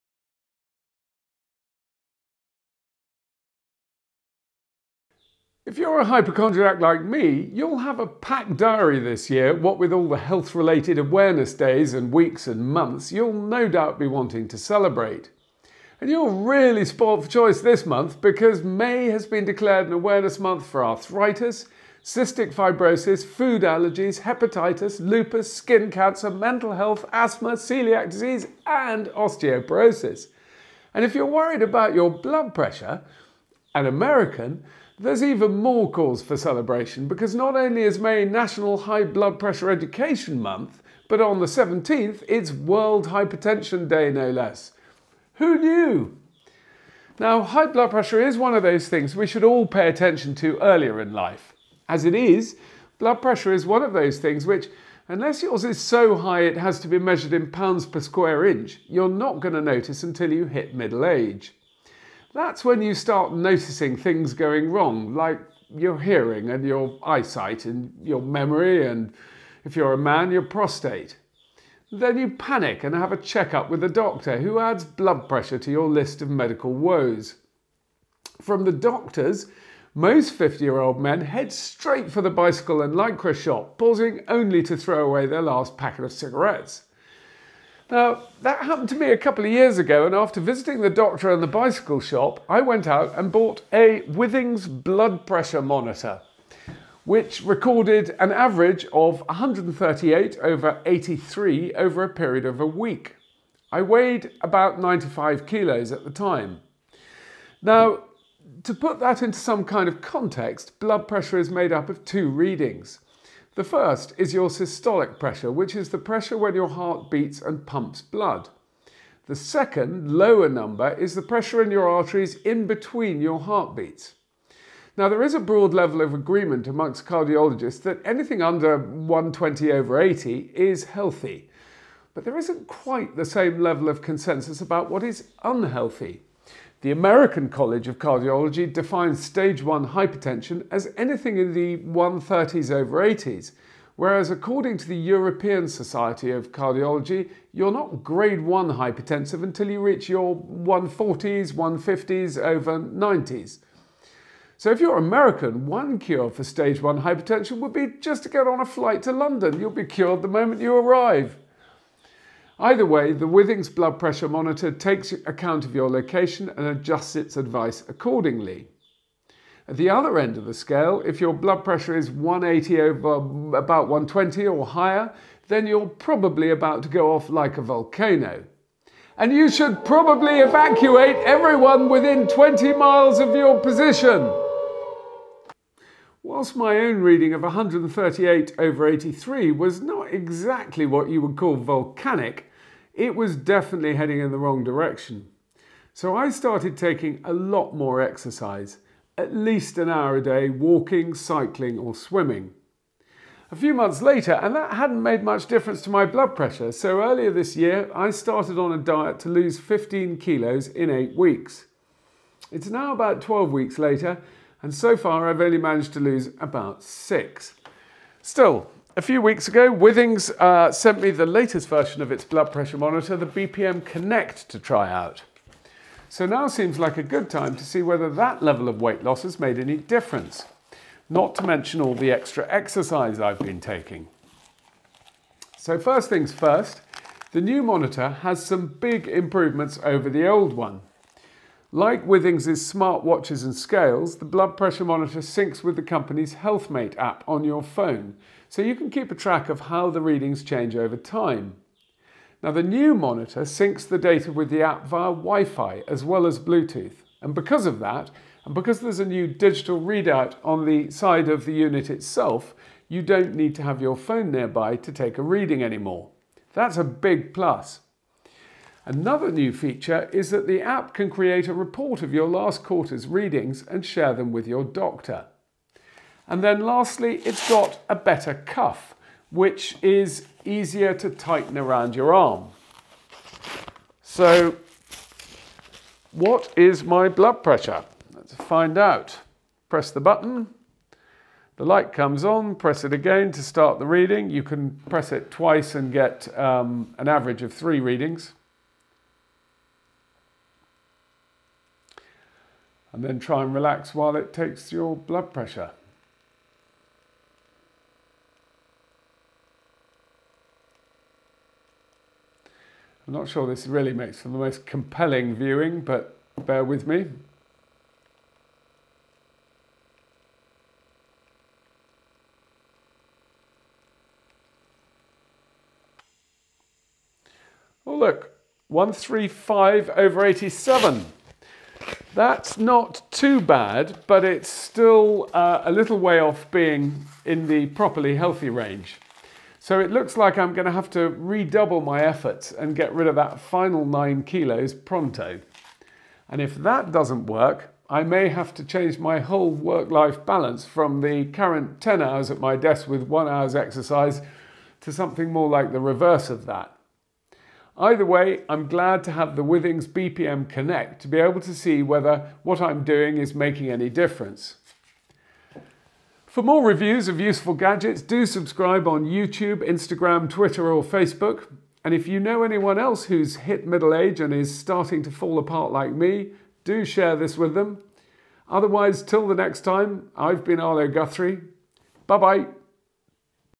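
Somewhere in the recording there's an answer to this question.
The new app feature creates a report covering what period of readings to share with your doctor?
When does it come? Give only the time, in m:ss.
4:32.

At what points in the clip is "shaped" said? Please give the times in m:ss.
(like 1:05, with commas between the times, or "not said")
not said.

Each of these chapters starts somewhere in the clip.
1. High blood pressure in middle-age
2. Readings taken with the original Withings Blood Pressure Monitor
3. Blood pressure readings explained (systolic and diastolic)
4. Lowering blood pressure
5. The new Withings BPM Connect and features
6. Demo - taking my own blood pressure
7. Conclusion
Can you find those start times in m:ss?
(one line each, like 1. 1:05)
1. 0:46
2. 1:32
3. 1:47
4. 3:05
5. 3:38
6. 4:43
7. 5:31.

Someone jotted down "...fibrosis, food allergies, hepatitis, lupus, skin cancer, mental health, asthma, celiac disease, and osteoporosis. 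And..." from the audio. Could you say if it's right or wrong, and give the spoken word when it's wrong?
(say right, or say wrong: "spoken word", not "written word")
right.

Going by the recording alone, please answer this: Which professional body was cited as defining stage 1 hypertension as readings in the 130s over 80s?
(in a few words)
American College of Cardiology.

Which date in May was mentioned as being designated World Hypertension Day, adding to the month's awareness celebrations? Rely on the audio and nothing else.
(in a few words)
17th.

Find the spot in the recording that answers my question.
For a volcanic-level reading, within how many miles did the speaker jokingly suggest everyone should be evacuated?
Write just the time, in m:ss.
3:02.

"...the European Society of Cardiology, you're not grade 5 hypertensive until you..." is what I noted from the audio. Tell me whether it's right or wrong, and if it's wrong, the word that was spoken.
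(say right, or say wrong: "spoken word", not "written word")
wrong: "1", not "5".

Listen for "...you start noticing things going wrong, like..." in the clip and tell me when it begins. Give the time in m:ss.
1:02.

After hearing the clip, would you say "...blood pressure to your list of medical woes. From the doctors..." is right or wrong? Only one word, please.
right.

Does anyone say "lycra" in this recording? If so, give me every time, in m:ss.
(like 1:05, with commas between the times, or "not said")
1:22.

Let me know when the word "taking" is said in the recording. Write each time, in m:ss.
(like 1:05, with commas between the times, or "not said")
3:16, 3:53.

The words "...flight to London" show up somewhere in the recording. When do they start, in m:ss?
2:38.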